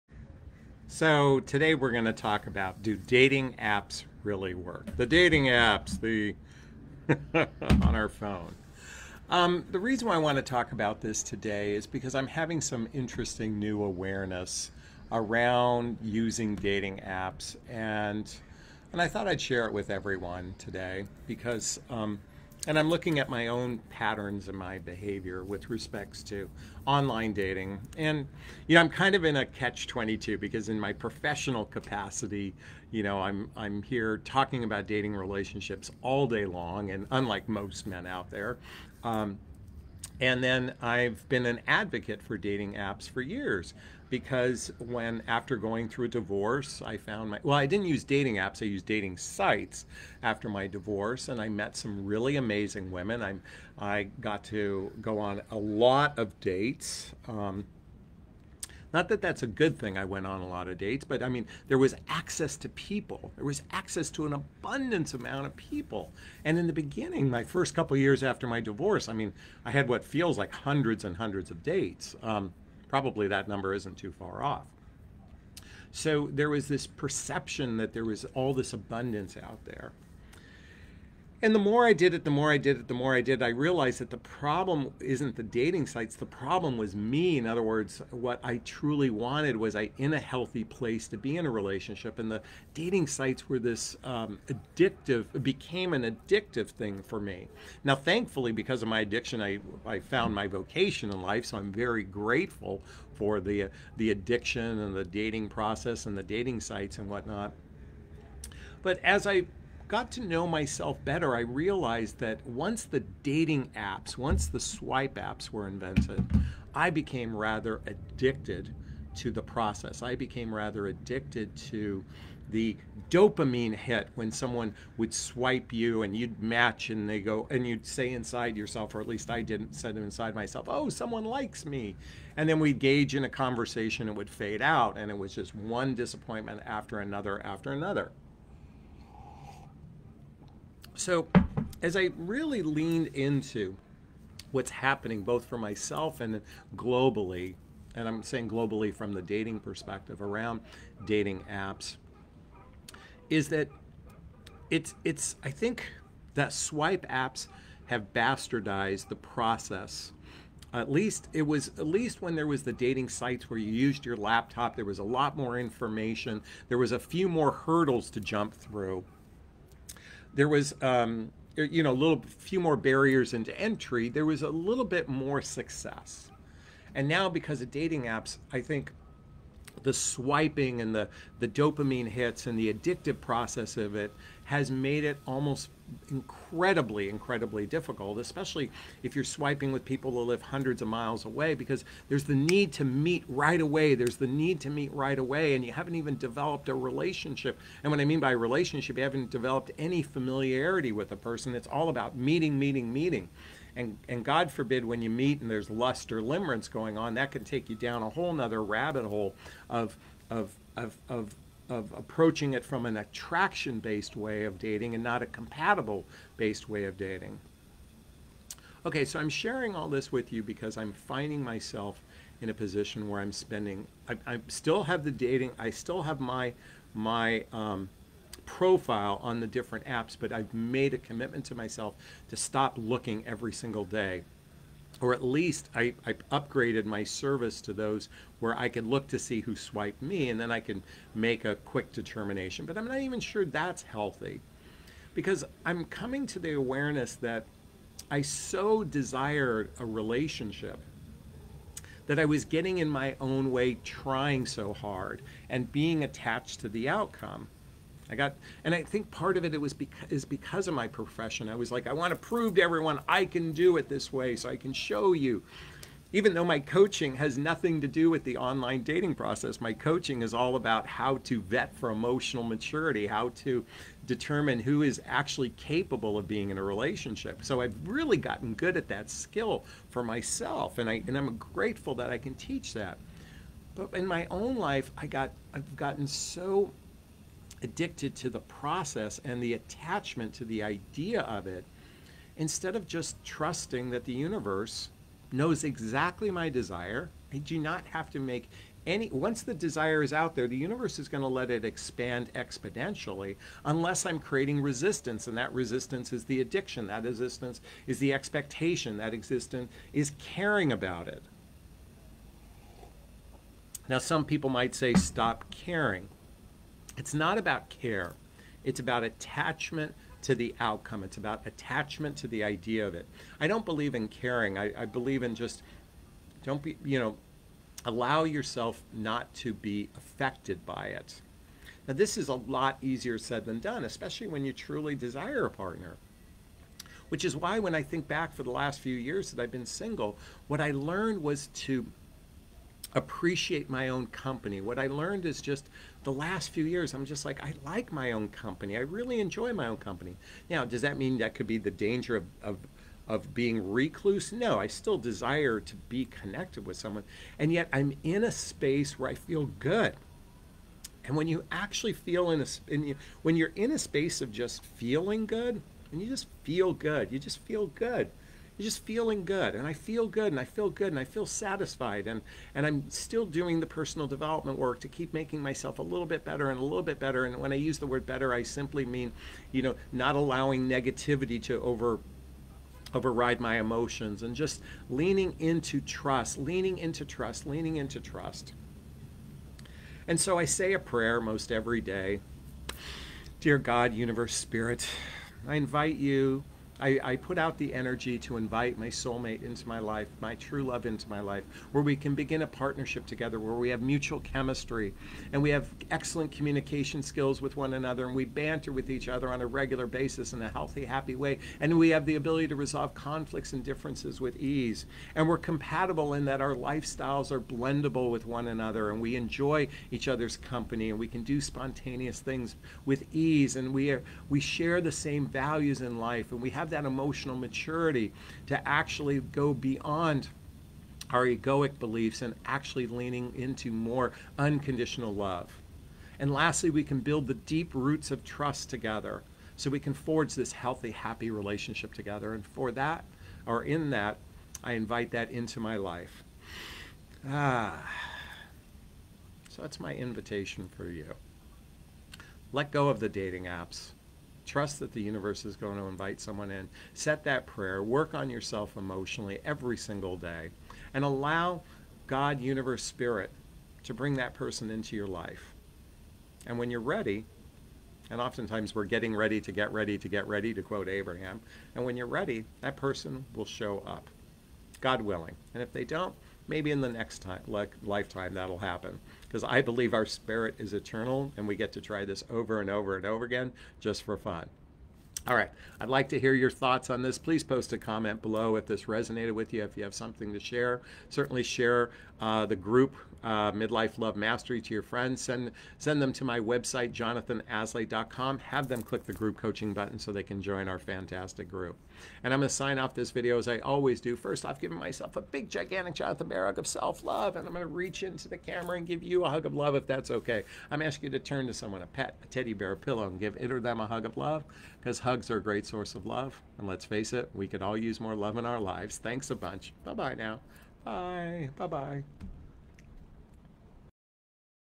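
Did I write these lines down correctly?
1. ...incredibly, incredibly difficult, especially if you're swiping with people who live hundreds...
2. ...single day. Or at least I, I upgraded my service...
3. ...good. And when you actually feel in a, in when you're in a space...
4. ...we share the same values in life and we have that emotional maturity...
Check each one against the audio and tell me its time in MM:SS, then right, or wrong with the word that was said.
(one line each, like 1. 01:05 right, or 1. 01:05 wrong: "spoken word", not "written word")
1. 03:06 right
2. 03:53 right
3. 05:59 right
4. 07:04 right.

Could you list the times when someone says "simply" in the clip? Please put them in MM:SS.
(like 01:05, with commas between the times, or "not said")
06:18.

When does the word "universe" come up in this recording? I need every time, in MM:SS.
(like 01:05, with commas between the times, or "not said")
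04:54, 05:00, 06:33, 07:35, 07:42.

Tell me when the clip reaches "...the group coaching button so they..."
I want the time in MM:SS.
08:19.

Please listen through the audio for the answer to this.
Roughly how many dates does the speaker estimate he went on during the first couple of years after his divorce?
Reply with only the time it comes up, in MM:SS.
01:10.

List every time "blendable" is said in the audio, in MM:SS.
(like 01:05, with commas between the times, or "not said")
06:57.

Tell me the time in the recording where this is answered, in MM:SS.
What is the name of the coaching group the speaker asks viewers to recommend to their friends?
08:13.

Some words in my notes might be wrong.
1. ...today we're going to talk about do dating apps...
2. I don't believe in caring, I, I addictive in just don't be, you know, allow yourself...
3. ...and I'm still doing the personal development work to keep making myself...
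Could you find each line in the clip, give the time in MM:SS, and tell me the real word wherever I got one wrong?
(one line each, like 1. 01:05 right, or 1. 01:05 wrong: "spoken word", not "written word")
1. 00:01 right
2. 05:23 wrong: "believe", not "addictive"
3. 06:12 right.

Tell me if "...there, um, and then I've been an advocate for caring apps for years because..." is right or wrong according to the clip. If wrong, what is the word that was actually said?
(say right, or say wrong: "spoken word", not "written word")
wrong: "dating", not "caring".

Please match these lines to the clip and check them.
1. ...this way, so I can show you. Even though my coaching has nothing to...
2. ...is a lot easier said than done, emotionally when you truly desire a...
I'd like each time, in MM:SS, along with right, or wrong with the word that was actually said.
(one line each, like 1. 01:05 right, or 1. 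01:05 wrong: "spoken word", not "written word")
1. 04:23 right
2. 05:32 wrong: "especially", not "emotionally".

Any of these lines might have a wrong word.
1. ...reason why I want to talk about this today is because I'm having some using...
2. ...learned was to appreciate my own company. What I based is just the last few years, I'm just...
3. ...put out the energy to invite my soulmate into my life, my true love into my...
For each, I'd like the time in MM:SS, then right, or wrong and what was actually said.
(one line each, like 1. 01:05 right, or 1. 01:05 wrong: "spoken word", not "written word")
1. 00:09 wrong: "interesting", not "using"
2. 05:40 wrong: "learned", not "based"
3. 06:37 right.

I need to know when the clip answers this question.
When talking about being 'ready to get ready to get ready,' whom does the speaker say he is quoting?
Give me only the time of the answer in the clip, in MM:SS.
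07:50.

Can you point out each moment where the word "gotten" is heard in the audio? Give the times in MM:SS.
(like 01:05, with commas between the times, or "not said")
04:38, 04:45.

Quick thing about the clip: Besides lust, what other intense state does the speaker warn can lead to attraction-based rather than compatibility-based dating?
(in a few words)
limerence.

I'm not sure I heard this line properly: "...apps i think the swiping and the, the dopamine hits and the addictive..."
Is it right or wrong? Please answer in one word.
right.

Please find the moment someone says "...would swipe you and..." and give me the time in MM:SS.
02:04.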